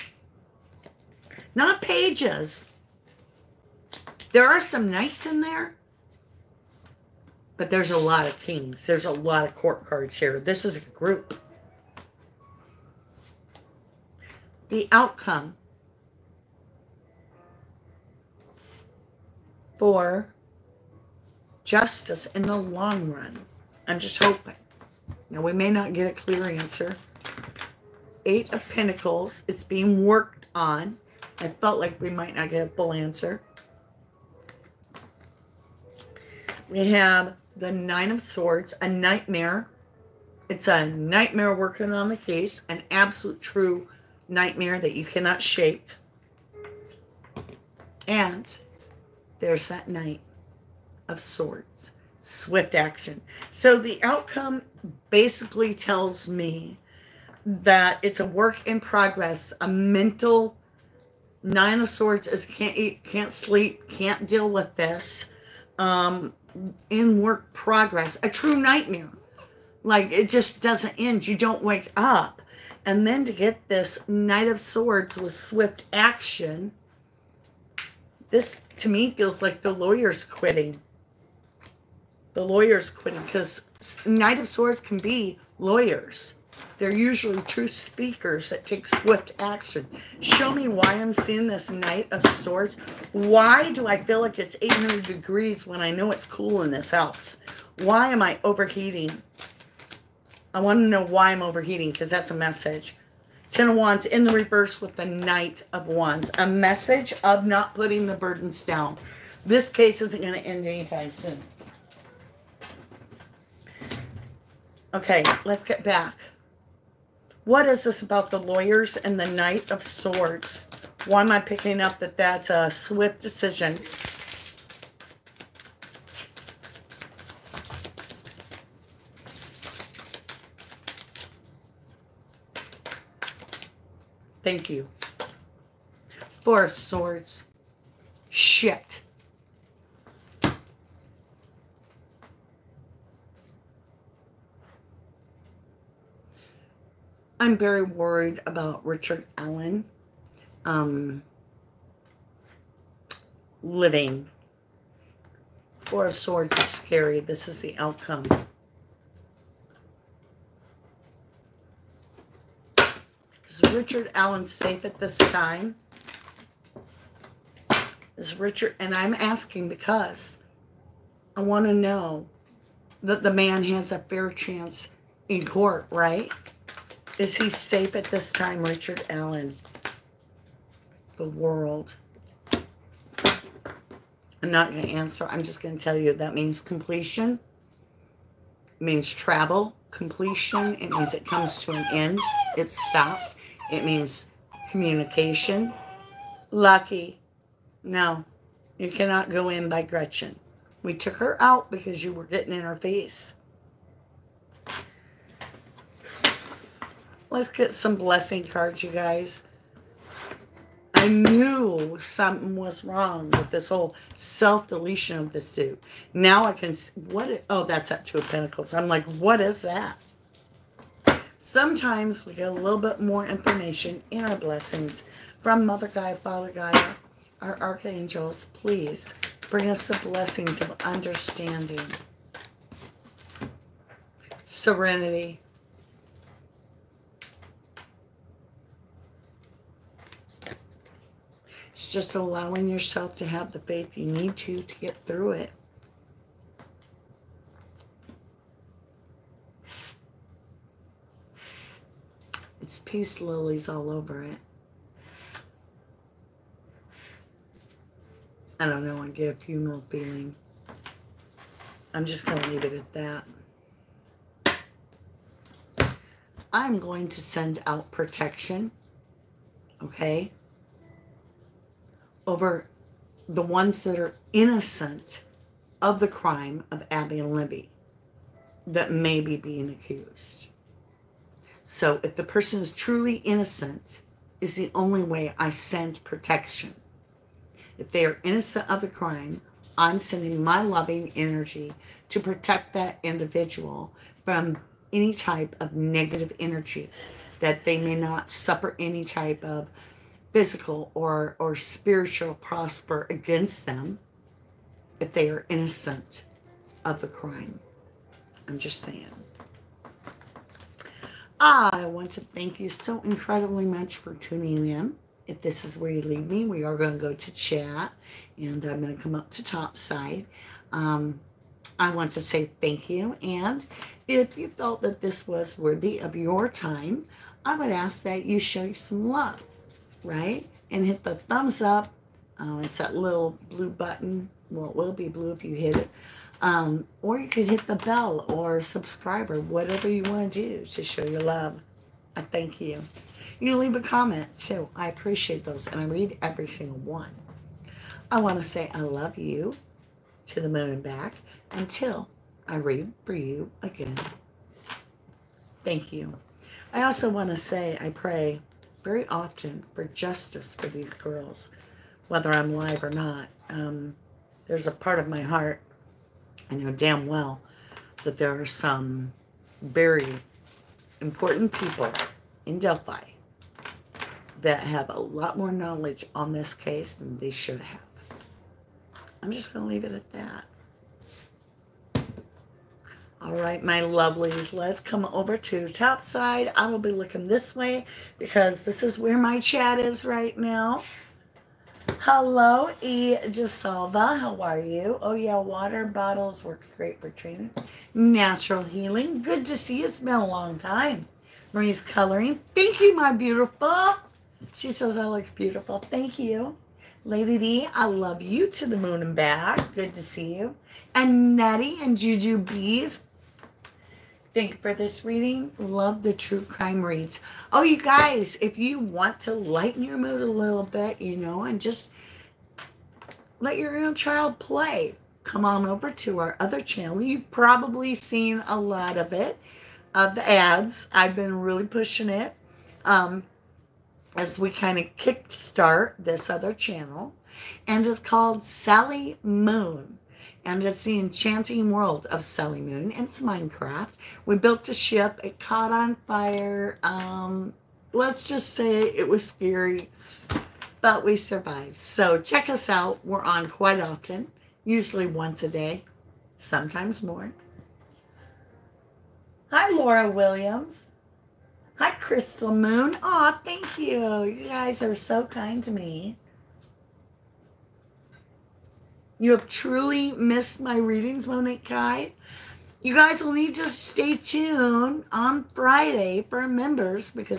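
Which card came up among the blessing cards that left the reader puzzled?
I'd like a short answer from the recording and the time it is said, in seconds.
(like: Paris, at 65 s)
Two of Pentacles, at 218 s.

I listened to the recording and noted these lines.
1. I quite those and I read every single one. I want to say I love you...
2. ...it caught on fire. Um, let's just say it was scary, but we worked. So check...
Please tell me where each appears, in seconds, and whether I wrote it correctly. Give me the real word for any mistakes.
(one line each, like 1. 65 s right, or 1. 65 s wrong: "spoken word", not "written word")
1. 344 s wrong: "appreciate", not "quite"
2. 445 s wrong: "survived", not "worked".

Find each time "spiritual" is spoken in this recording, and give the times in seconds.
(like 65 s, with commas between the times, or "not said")
301 s.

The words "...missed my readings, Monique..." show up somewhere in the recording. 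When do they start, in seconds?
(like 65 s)
470 s.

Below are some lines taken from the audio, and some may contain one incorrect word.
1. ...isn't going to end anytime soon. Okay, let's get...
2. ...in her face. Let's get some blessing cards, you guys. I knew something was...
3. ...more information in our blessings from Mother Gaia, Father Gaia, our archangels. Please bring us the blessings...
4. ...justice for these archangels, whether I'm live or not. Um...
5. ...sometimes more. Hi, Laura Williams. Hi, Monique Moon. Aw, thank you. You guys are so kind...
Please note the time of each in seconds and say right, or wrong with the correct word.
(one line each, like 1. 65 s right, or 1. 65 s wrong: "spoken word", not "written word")
1. 110 s right
2. 202 s right
3. 223 s right
4. 359 s wrong: "girls", not "archangels"
5. 456 s wrong: "Crystal", not "Monique".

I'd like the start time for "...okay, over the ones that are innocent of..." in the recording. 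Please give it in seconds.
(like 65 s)
269 s.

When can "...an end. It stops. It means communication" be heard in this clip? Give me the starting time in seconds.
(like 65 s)
191 s.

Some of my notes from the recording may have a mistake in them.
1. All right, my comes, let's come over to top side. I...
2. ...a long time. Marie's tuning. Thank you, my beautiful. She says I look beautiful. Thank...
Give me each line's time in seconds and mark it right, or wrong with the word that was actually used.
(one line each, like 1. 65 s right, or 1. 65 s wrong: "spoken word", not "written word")
1. 383 s wrong: "lovelies", not "comes"
2. 400 s wrong: "coloring", not "tuning".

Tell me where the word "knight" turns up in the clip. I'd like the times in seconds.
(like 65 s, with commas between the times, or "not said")
4 s, 49 s, 74 s, 84 s, 91 s, 105 s, 119 s.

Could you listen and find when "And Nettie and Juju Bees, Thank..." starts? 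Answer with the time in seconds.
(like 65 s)
410 s.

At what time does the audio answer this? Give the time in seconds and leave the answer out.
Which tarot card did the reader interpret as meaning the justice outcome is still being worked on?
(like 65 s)
28 s.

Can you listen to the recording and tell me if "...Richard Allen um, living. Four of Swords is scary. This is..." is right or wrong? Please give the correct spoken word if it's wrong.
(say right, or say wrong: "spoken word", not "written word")
right.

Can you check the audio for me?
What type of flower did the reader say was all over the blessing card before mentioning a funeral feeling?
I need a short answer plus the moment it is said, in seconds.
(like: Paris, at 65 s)
Peace lilies, at 252 s.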